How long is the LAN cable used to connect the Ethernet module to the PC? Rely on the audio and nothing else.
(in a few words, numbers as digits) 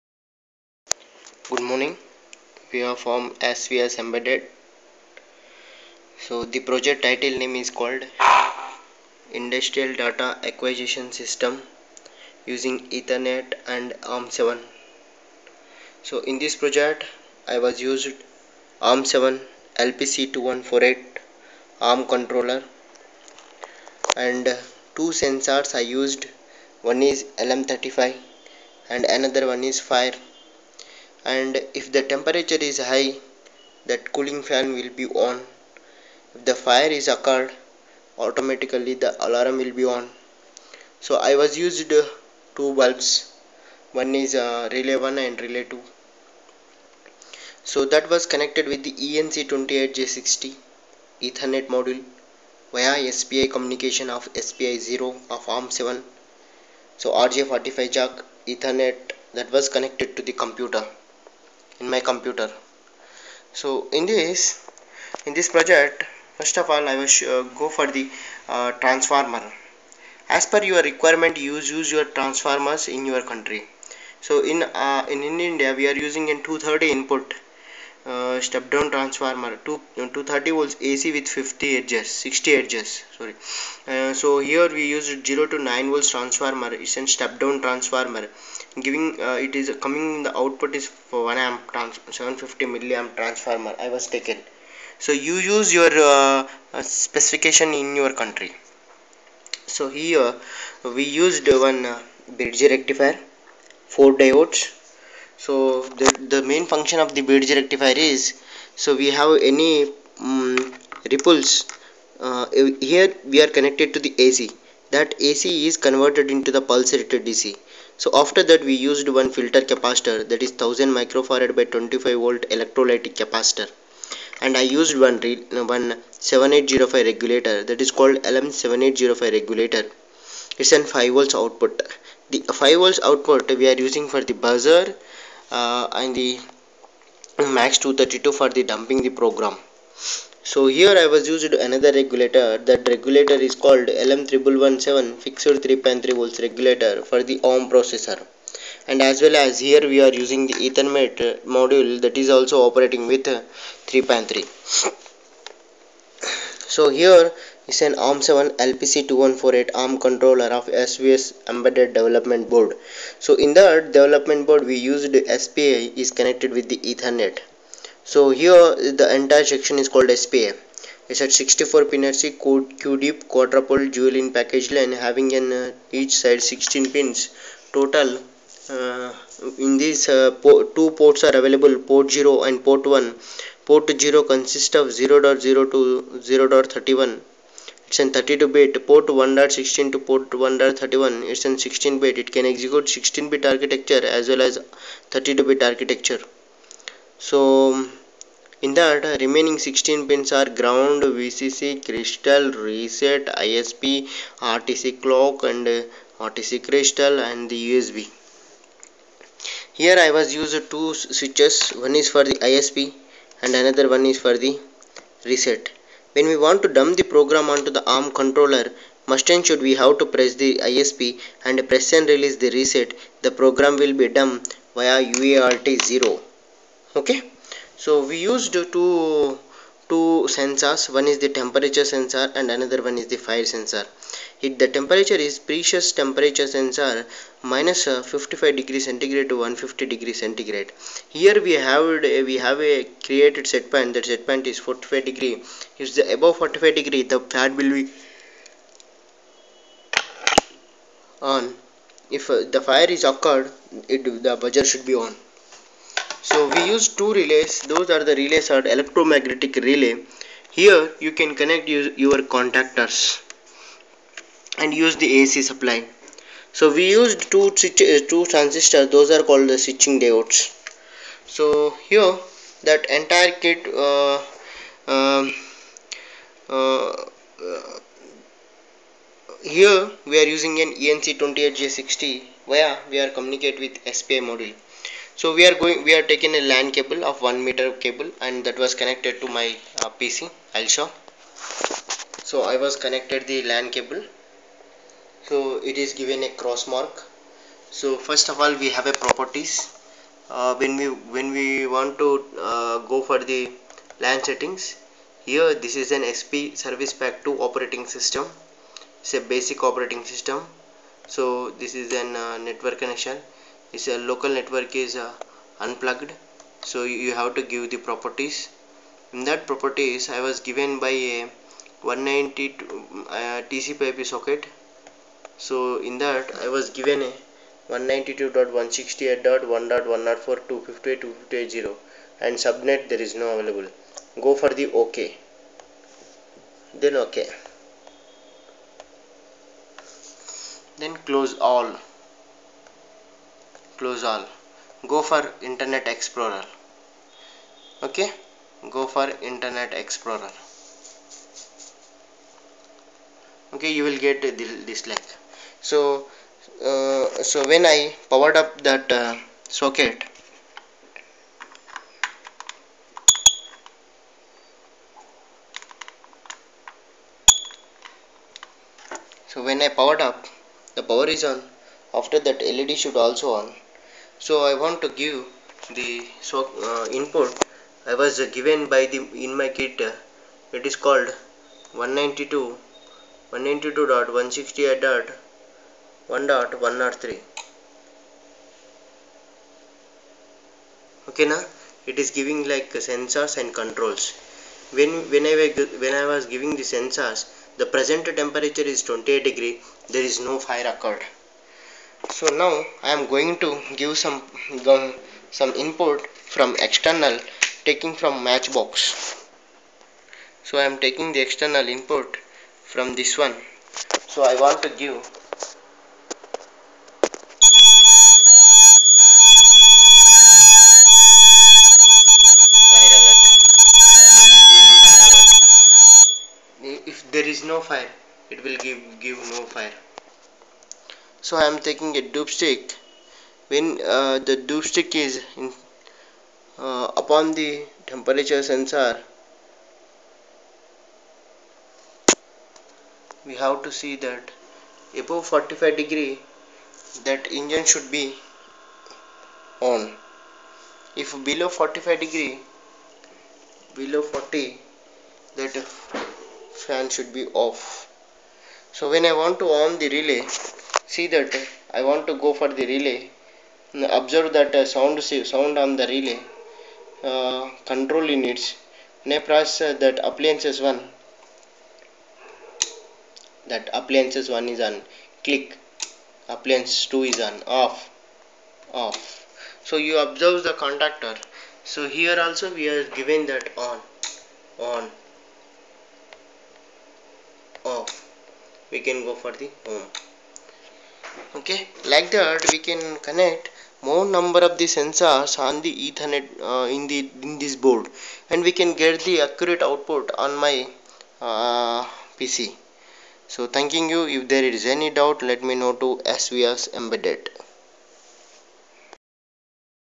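1 meter.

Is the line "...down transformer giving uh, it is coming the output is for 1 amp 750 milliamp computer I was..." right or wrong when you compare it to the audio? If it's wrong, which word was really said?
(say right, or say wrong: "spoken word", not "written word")
wrong: "transformer", not "computer".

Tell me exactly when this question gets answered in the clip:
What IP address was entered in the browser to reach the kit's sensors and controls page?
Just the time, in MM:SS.
06:23.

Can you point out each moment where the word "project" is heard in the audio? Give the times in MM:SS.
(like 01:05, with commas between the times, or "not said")
00:06, 00:16, 01:05.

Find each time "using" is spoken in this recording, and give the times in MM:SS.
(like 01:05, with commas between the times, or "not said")
00:12, 01:16, 02:13, 02:30, 04:40.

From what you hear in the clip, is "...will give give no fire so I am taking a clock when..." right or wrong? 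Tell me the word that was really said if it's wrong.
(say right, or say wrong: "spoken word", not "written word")
wrong: "dubstick", not "clock".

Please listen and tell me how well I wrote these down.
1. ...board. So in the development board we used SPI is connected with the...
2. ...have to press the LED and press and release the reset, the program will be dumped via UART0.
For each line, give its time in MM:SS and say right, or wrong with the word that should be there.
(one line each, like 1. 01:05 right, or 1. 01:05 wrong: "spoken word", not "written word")
1. 02:42 right
2. 03:39 wrong: "ISP", not "LED".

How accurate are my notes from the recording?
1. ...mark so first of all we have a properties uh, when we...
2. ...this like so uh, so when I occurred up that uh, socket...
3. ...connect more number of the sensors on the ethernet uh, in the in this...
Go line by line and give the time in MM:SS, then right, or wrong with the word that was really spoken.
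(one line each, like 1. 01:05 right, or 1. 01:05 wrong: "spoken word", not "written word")
1. 04:56 right
2. 05:54 wrong: "powered", not "occurred"
3. 08:13 right.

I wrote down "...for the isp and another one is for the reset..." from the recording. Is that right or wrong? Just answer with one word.
right.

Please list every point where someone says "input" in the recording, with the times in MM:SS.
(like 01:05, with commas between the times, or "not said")
01:16, 06:16, 06:45, 06:51.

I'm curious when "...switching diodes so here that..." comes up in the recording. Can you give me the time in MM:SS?
04:29.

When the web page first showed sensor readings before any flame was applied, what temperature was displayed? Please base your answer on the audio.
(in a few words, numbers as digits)
28 degrees.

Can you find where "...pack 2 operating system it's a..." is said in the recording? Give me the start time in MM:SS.
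05:07.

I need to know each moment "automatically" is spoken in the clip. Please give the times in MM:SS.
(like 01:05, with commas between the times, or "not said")
00:38.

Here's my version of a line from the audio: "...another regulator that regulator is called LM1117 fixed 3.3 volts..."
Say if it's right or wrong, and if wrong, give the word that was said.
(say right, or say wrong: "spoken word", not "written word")
right.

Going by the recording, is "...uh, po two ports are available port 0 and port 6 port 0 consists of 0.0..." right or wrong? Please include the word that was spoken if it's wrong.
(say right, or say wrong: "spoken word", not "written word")
wrong: "1", not "6".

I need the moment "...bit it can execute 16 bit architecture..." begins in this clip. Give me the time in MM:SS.
03:12.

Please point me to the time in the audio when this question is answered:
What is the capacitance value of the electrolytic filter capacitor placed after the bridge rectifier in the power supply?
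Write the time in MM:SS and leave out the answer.
02:00.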